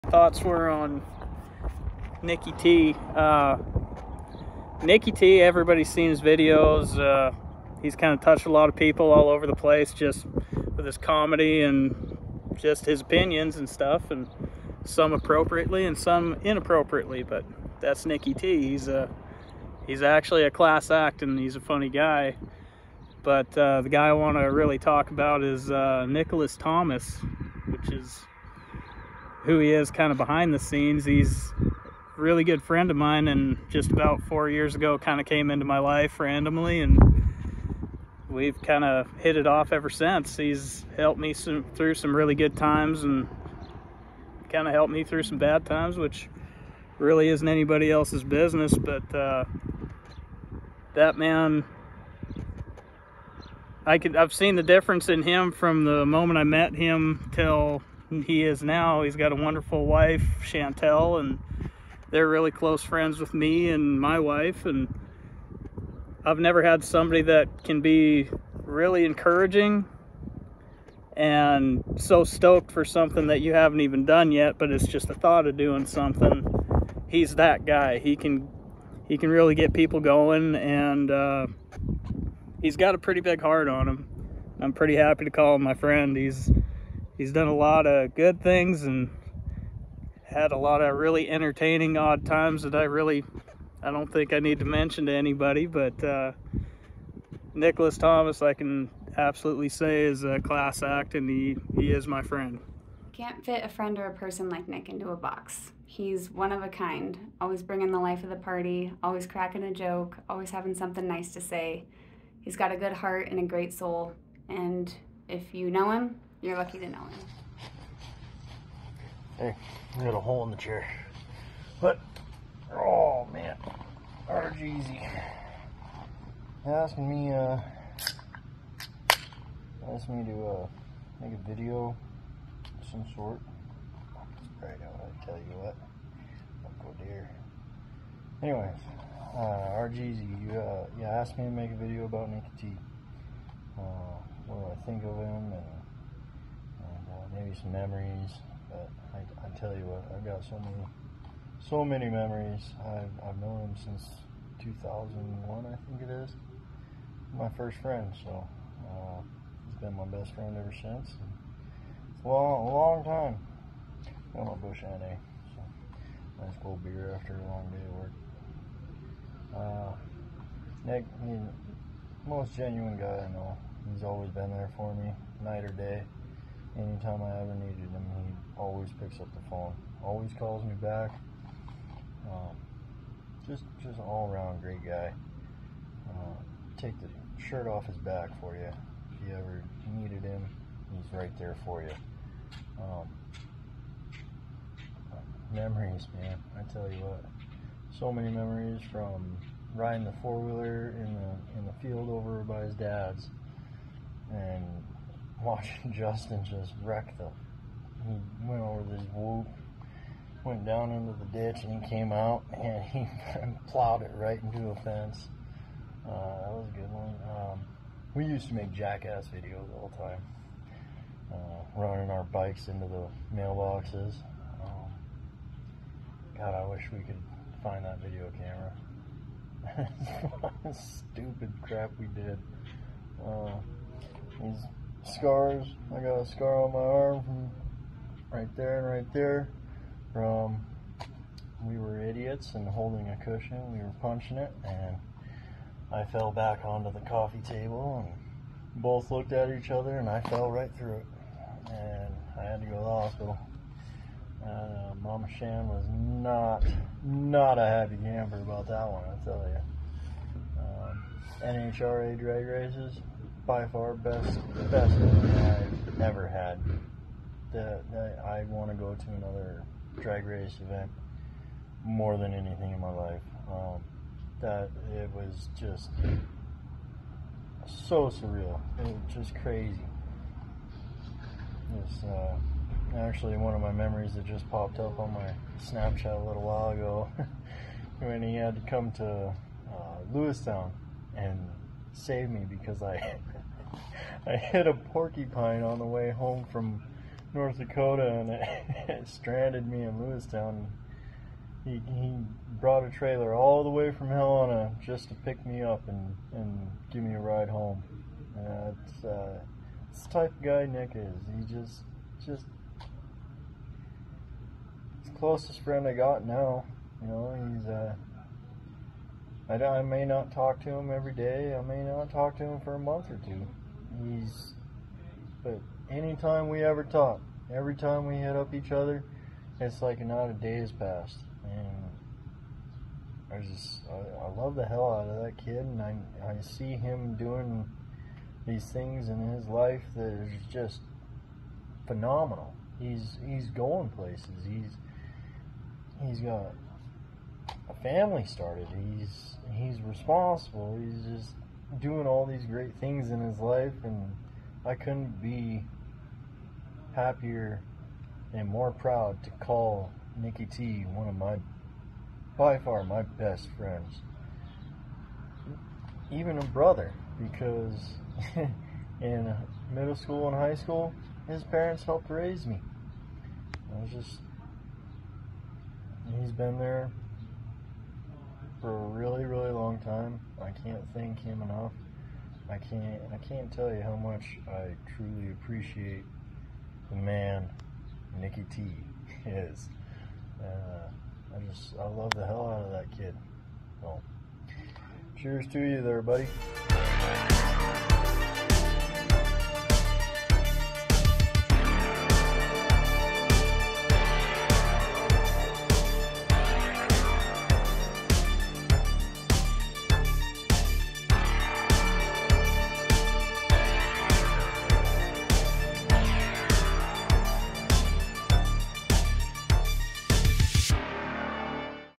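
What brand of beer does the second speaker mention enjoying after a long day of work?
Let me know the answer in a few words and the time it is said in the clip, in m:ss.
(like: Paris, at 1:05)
Busch NA, at 2:44.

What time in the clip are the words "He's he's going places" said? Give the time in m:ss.
5:42.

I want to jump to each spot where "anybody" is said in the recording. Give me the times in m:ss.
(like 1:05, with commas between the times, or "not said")
0:47, 1:35.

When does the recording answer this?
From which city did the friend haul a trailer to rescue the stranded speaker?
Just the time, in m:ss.
5:04.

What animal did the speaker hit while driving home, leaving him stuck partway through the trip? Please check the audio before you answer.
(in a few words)
A porcupine.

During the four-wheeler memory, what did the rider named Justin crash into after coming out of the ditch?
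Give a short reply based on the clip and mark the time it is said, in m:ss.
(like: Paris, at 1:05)
A fence, at 3:34.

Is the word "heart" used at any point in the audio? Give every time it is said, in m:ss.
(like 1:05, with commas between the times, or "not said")
1:23, 1:52.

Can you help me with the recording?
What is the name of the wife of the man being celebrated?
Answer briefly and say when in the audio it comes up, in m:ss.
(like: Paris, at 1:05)
Chantel, at 1:00.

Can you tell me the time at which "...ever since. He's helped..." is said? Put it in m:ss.
0:39.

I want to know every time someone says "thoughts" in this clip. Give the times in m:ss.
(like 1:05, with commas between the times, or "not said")
0:00, 1:15.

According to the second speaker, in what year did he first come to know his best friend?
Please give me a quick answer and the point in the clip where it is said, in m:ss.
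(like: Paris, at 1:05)
2001, at 2:34.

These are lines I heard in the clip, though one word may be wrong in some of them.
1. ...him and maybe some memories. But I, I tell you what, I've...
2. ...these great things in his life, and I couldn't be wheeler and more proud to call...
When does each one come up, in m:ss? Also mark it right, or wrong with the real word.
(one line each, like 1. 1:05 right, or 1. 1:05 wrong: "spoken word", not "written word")
1. 2:25 right
2. 5:52 wrong: "happier", not "wheeler".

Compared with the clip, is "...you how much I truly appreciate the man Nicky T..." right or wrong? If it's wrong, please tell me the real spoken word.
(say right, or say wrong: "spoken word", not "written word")
right.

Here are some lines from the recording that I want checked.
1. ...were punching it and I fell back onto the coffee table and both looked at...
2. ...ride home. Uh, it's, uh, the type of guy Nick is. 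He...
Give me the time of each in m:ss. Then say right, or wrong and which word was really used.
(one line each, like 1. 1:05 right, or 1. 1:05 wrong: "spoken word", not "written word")
1. 4:03 right
2. 5:07 right.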